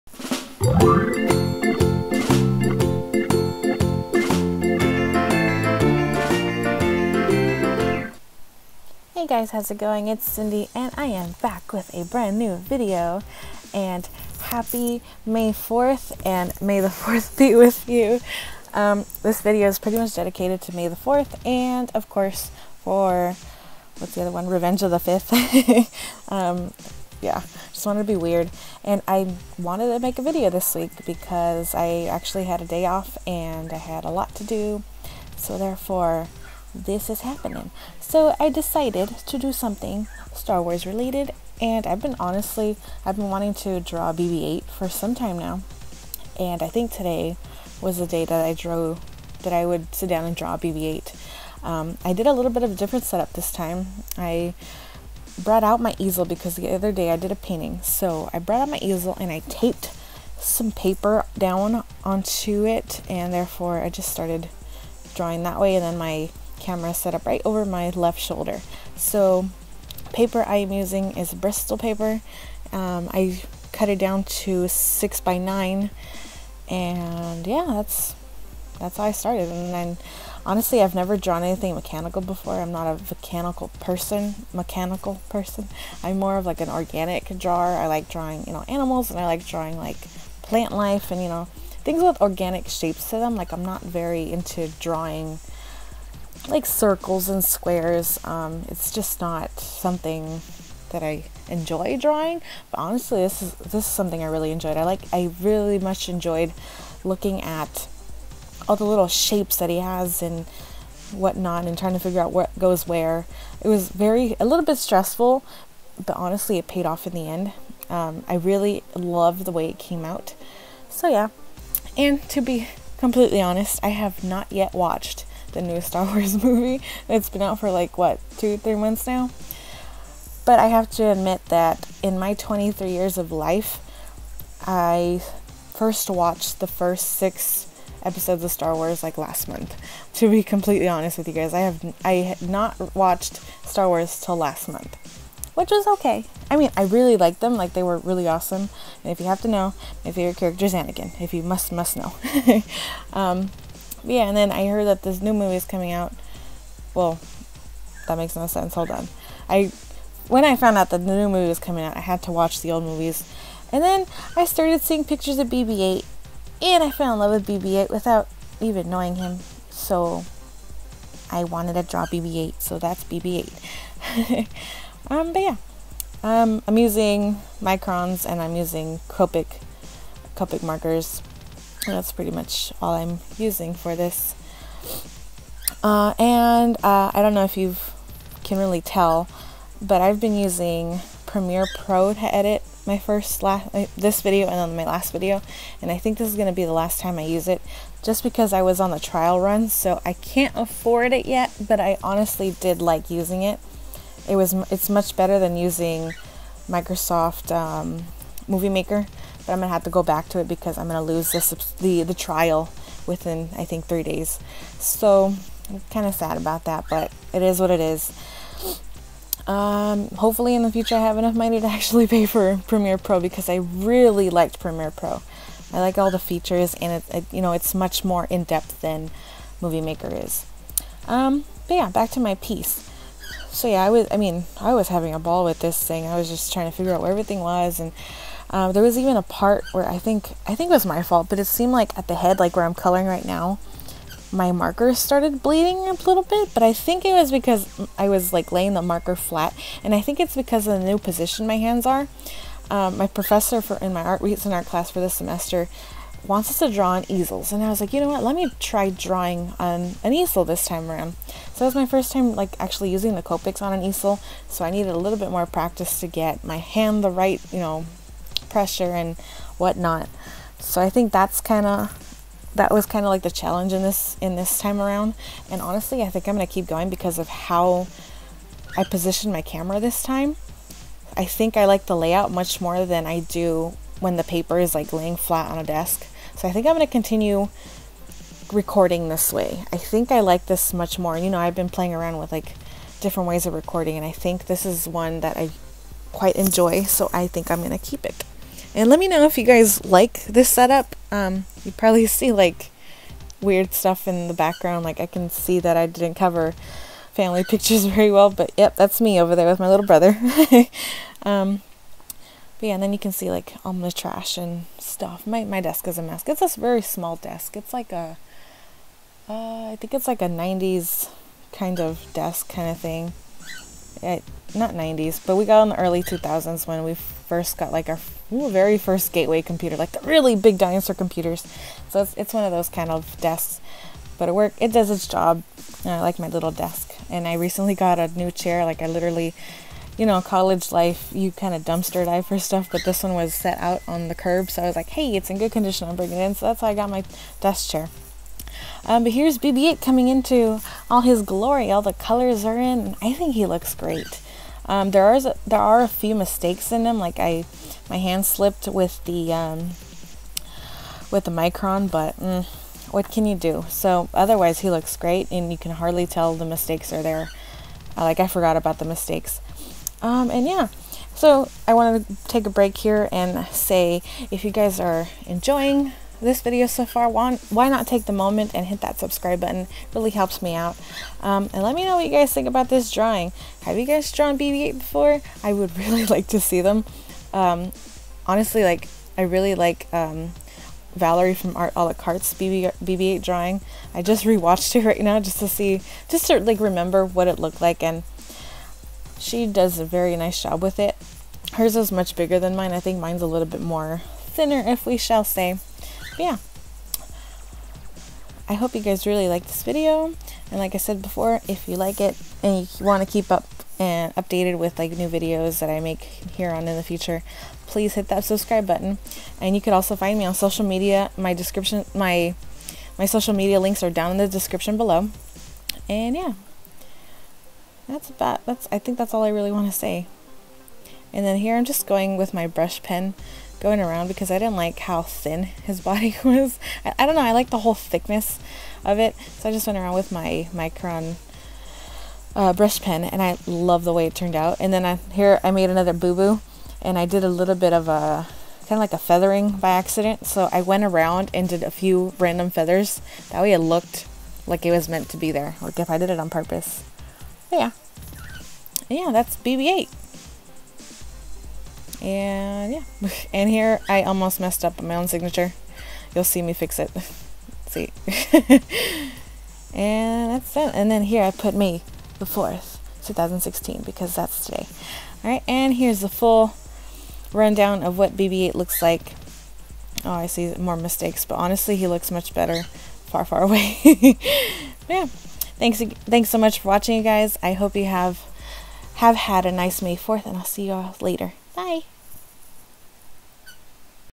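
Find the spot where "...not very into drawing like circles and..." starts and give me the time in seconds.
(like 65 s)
93 s.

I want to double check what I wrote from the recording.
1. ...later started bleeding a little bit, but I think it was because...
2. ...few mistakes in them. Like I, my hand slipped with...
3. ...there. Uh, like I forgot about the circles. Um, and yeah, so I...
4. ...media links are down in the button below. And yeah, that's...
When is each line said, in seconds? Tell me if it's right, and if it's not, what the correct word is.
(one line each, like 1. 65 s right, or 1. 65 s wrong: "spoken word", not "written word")
1. 244 s wrong: "marker", not "later"
2. 355 s right
3. 367 s wrong: "mistakes", not "circles"
4. 423 s wrong: "description", not "button".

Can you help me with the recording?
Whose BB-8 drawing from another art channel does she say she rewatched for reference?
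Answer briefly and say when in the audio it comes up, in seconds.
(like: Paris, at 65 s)
Valerie, at 390 s.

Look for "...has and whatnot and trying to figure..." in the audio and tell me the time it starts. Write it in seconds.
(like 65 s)
109 s.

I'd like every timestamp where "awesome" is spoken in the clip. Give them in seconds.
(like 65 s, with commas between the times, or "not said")
148 s.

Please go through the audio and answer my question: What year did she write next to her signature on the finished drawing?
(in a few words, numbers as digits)
2016.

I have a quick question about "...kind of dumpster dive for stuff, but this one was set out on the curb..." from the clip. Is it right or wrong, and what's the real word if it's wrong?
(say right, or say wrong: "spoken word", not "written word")
right.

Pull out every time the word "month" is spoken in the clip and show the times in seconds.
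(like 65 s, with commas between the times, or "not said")
128 s, 139 s, 144 s.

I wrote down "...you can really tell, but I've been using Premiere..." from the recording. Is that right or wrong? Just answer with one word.
right.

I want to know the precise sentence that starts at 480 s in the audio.
Oh, I see more mistakes, but honestly, he looks much better far, far away.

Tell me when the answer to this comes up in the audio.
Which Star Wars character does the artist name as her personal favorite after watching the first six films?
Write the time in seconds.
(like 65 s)
150 s.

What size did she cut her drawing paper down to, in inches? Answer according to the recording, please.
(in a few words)
6 by 9.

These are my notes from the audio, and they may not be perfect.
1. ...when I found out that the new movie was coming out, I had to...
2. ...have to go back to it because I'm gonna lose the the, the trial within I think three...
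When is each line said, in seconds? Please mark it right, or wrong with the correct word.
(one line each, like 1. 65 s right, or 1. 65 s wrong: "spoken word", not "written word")
1. 160 s right
2. 209 s right.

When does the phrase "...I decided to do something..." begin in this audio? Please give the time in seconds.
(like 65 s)
38 s.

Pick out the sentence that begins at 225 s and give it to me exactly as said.
I like all the features, and it, it you know it's much more in depth than Movie Maker is.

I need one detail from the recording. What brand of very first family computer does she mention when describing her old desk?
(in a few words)
Gateway.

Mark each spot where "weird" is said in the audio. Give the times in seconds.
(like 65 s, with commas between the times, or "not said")
28 s, 303 s.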